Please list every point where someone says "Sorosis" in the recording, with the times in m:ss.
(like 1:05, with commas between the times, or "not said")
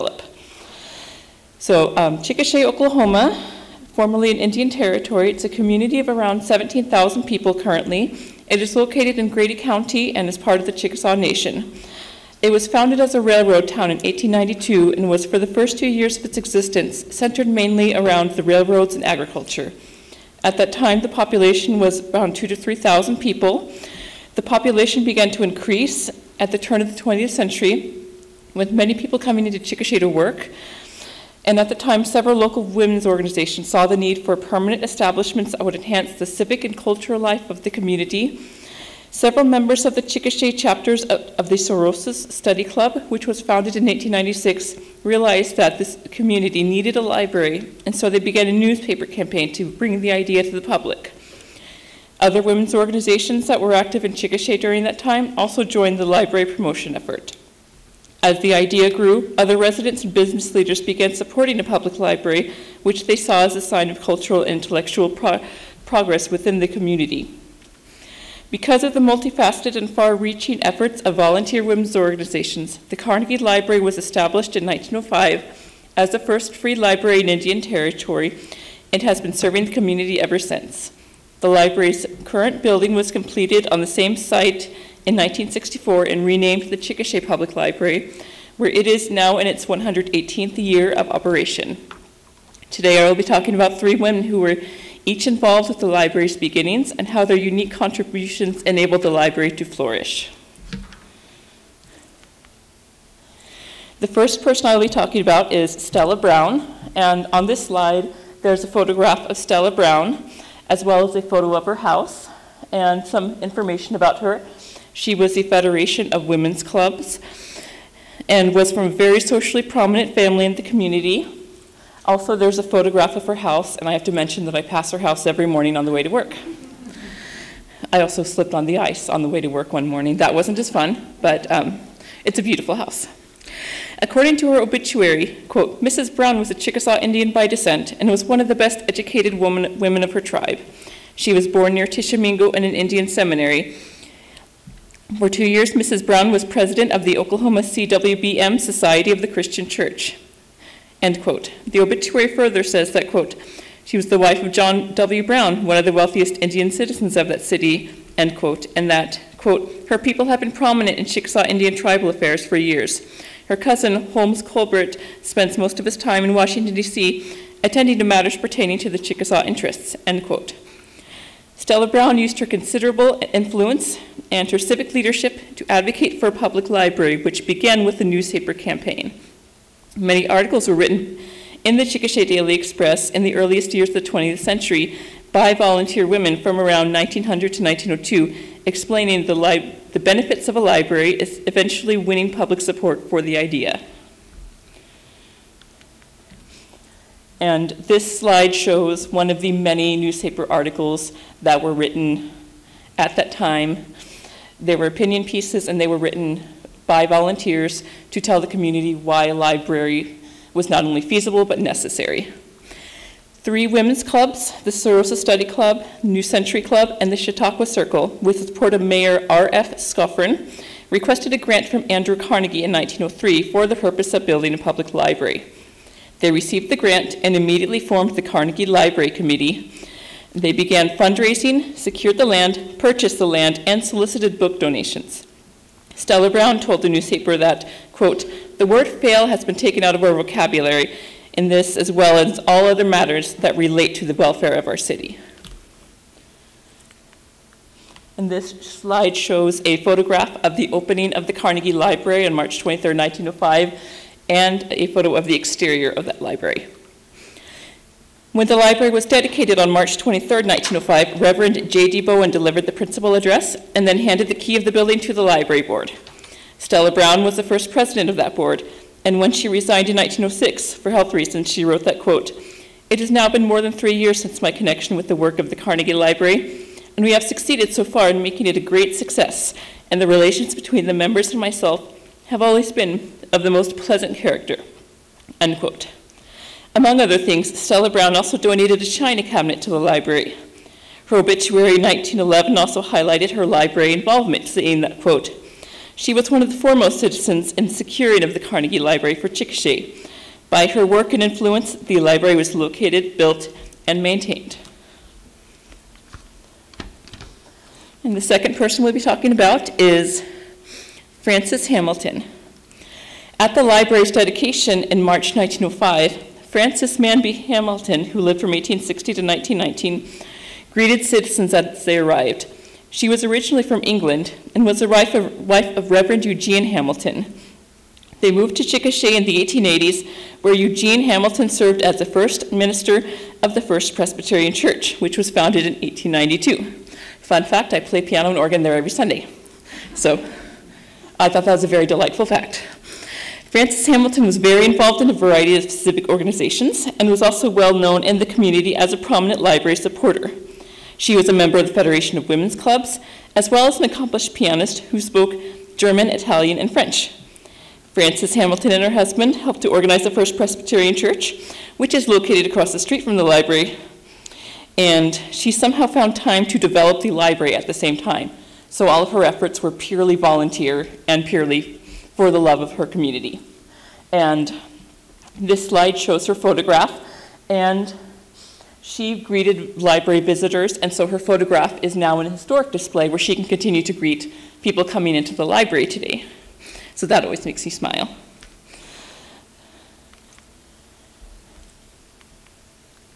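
0:41, 3:34.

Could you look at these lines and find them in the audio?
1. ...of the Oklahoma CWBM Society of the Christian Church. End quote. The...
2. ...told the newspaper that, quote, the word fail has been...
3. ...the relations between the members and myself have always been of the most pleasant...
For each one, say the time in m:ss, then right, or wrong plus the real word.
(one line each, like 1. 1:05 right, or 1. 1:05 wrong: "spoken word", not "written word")
1. 2:26 right
2. 3:56 right
3. 4:40 right.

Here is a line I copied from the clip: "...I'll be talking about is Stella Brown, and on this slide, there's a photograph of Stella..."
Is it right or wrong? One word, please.
right.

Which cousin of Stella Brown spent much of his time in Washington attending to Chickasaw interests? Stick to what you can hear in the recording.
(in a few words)
Holmes Colbert.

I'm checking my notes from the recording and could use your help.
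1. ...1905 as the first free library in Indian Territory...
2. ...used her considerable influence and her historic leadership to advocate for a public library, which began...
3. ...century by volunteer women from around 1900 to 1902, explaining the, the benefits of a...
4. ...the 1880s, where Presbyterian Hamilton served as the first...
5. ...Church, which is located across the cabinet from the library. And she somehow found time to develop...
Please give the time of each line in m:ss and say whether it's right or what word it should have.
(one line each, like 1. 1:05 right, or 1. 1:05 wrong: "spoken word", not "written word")
1. 1:14 right
2. 2:52 wrong: "civic", not "historic"
3. 3:04 right
4. 5:29 wrong: "Eugene", not "Presbyterian"
5. 6:00 wrong: "street", not "cabinet".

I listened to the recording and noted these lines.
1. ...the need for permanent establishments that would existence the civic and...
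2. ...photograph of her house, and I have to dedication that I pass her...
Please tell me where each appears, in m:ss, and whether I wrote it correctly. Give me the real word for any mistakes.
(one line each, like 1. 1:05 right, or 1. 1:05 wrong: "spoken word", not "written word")
1. 0:33 wrong: "enhance", not "existence"
2. 2:02 wrong: "mention", not "dedication".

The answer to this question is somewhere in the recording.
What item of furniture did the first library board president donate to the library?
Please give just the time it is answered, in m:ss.
4:48.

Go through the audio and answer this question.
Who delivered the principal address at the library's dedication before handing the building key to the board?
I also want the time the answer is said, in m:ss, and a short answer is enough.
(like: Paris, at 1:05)
Reverend J.D. Bowen, at 4:21.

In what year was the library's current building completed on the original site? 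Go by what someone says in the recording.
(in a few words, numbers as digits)
1964.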